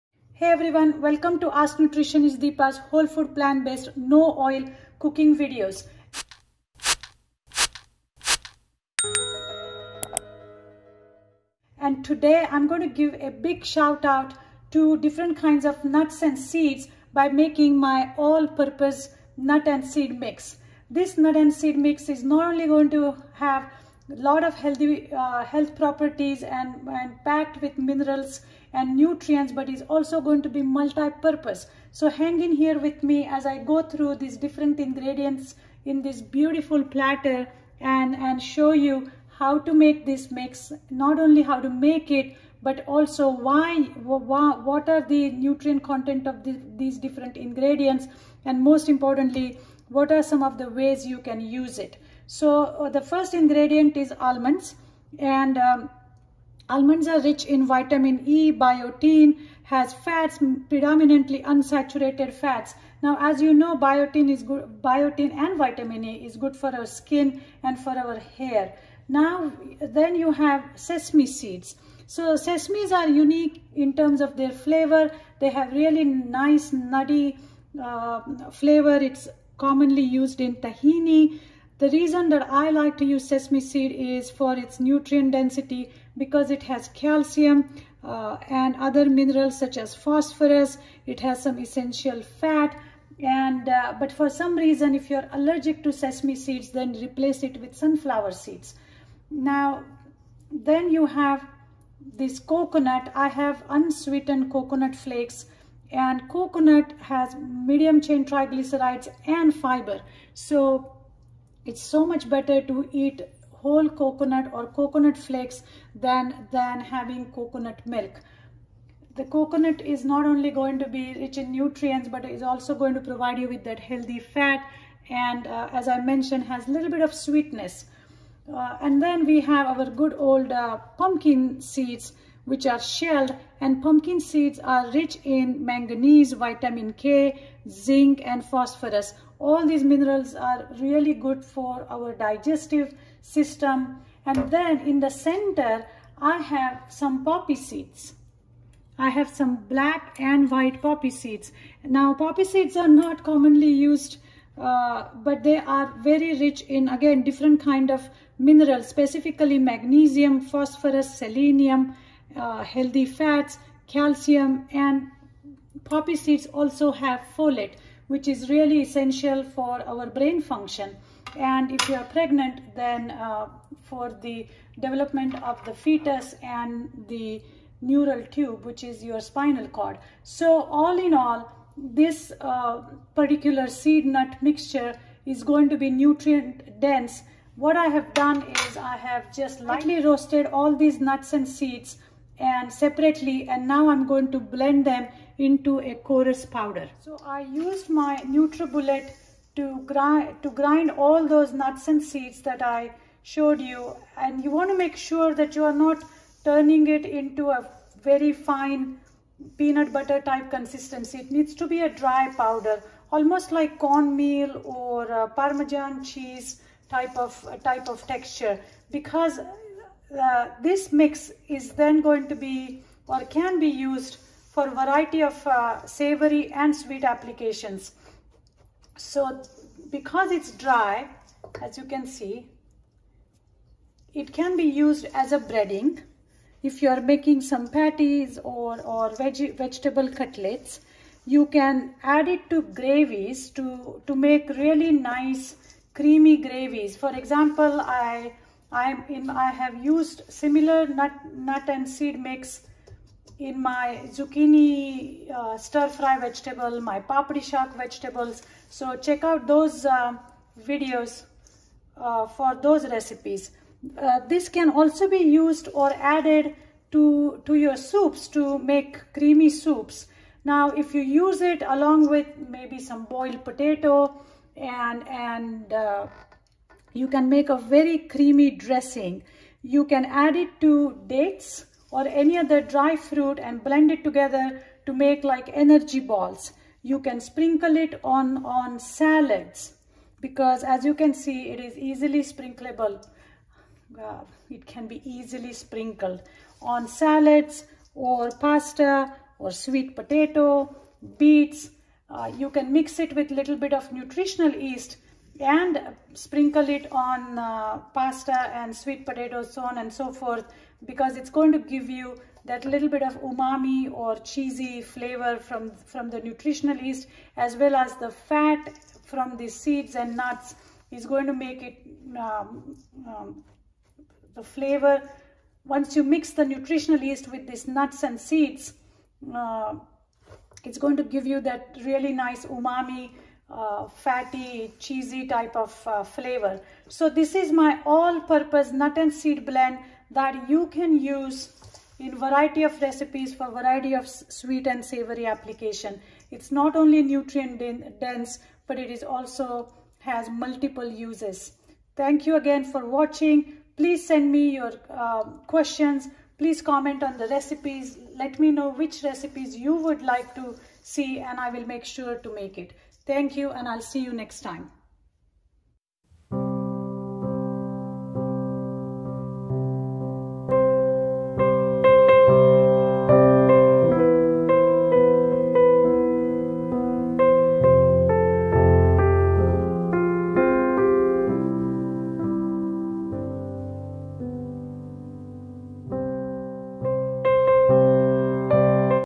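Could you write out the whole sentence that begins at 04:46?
You can sprinkle it on, on salads because as you can see, it is easily sprinklable.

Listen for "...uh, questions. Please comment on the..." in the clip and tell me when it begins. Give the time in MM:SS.
05:54.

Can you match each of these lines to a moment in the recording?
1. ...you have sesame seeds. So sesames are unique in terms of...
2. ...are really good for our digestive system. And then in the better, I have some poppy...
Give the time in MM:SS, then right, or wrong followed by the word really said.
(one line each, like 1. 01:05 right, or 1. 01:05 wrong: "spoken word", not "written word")
1. 01:10 right
2. 02:20 wrong: "center", not "better".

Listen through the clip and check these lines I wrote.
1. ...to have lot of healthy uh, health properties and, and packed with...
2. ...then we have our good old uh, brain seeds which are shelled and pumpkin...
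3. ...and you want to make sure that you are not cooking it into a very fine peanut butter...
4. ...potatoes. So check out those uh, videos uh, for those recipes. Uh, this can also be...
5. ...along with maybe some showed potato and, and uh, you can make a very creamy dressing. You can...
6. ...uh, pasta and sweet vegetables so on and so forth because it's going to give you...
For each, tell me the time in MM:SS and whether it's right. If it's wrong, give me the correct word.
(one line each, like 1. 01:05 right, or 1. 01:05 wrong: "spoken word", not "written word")
1. 00:22 right
2. 02:09 wrong: "pumpkin", not "brain"
3. 03:24 wrong: "turning", not "cooking"
4. 04:17 wrong: "vegetables", not "potatoes"
5. 04:31 wrong: "boiled", not "showed"
6. 05:07 wrong: "potatoes", not "vegetables".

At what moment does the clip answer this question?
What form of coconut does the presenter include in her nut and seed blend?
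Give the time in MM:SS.
01:43.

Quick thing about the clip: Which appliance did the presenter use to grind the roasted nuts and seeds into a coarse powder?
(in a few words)
NutriBullet.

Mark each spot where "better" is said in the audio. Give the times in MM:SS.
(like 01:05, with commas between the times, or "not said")
01:52.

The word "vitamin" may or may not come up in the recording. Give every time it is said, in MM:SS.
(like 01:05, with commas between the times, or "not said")
00:57, 01:05, 02:16.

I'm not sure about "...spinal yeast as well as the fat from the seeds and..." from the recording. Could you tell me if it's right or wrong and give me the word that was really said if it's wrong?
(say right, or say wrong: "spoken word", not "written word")
wrong: "nutritional", not "spinal".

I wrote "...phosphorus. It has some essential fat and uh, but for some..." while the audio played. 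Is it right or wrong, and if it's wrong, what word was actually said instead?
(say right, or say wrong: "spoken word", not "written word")
right.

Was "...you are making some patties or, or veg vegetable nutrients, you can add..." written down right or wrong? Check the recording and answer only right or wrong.
wrong.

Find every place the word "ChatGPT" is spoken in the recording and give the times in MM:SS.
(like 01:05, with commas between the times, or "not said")
not said.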